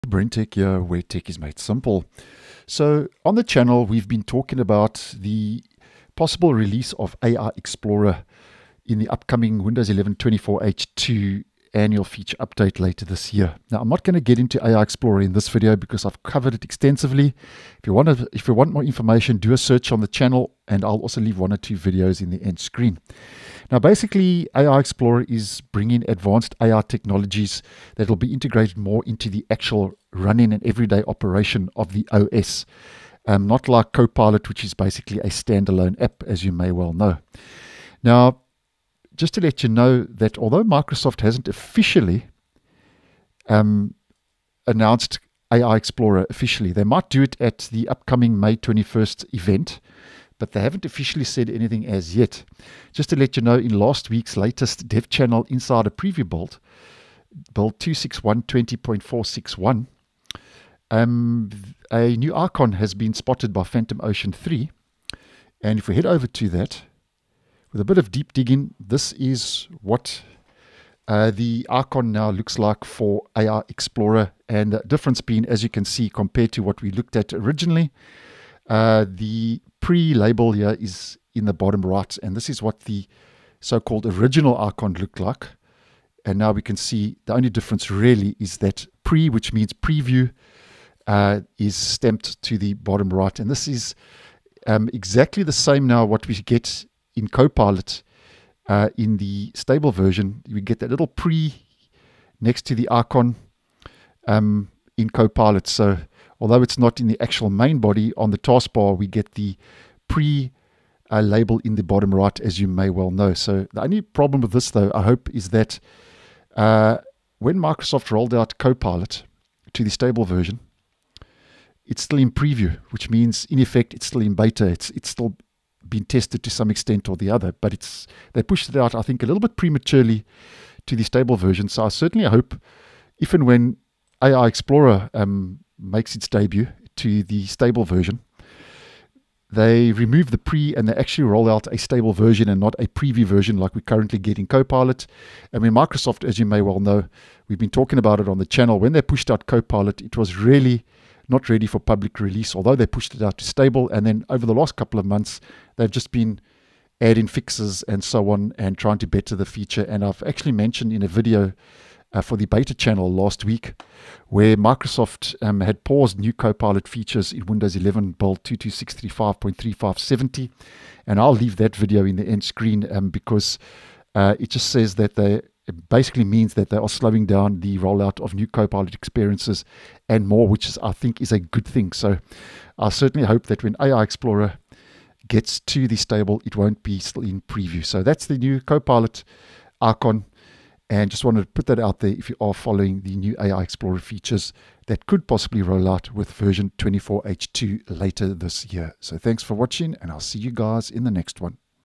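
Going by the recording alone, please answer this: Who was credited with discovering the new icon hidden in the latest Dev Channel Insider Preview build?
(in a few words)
PhantomOfEarth.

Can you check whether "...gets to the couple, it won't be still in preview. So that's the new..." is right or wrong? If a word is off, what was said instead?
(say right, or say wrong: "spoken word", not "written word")
wrong: "stable", not "couple".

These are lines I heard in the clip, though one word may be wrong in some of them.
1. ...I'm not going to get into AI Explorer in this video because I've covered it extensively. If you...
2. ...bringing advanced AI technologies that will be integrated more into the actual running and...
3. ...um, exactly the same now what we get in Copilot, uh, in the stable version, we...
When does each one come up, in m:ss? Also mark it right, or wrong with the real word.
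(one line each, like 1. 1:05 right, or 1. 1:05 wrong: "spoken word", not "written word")
1. 0:13 right
2. 0:25 right
3. 1:34 right.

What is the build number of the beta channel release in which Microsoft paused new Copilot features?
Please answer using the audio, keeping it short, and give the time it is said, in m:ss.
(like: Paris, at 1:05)
22635.3570, at 2:48.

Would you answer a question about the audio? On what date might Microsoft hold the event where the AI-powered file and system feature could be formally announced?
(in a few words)
May 21st.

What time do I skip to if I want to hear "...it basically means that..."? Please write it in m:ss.
2:55.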